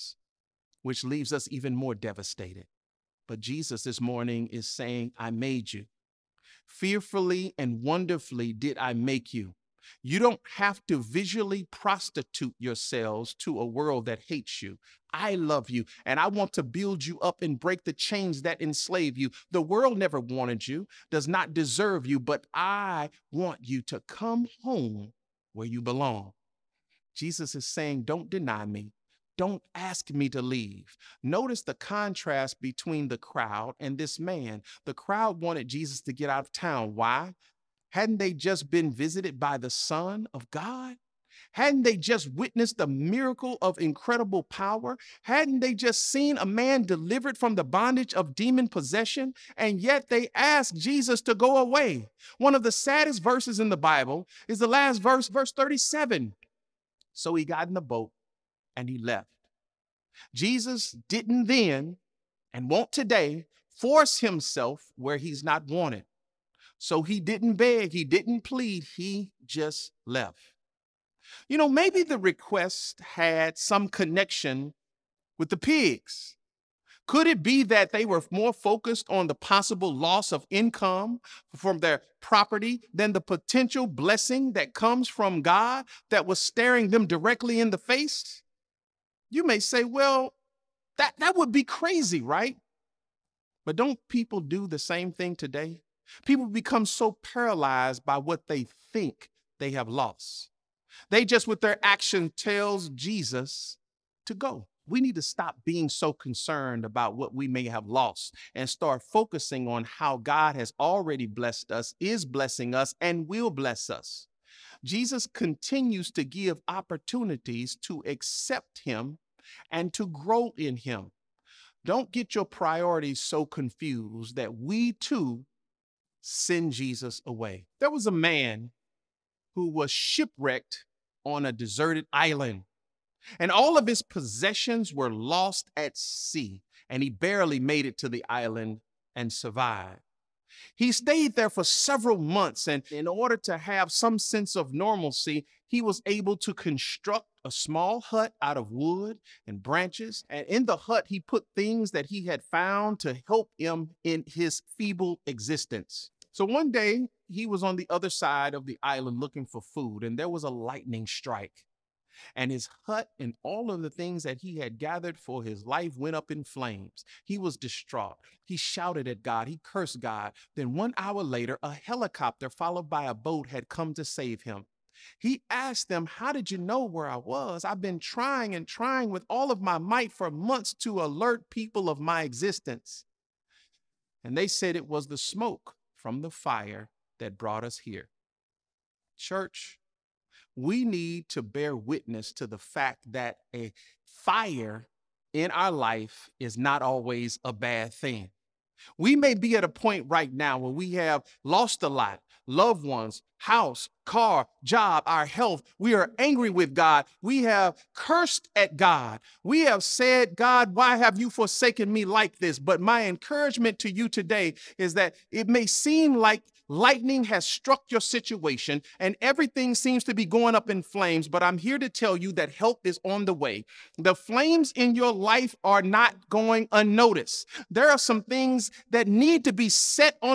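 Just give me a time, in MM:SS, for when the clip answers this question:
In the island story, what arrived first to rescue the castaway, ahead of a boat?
02:51.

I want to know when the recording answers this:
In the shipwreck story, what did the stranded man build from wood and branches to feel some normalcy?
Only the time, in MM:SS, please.
02:27.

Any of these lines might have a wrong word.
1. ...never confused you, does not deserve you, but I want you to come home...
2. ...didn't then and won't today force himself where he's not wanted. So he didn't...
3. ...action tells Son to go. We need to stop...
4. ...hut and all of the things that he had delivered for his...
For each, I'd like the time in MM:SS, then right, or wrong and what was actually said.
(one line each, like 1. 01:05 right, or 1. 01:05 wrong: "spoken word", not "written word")
1. 00:19 wrong: "wanted", not "confused"
2. 01:01 right
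3. 01:41 wrong: "Jesus", not "Son"
4. 02:42 wrong: "gathered", not "delivered".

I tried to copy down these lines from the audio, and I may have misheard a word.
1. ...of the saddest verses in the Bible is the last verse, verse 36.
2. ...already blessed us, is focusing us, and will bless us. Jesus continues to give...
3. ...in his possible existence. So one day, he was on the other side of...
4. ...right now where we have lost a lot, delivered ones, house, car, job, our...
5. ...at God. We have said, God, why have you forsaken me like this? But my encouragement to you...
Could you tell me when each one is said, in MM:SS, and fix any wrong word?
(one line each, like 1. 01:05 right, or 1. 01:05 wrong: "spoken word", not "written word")
1. 00:52 wrong: "37", not "36"
2. 01:50 wrong: "blessing", not "focusing"
3. 02:34 wrong: "feeble", not "possible"
4. 03:20 wrong: "loved", not "delivered"
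5. 03:28 right.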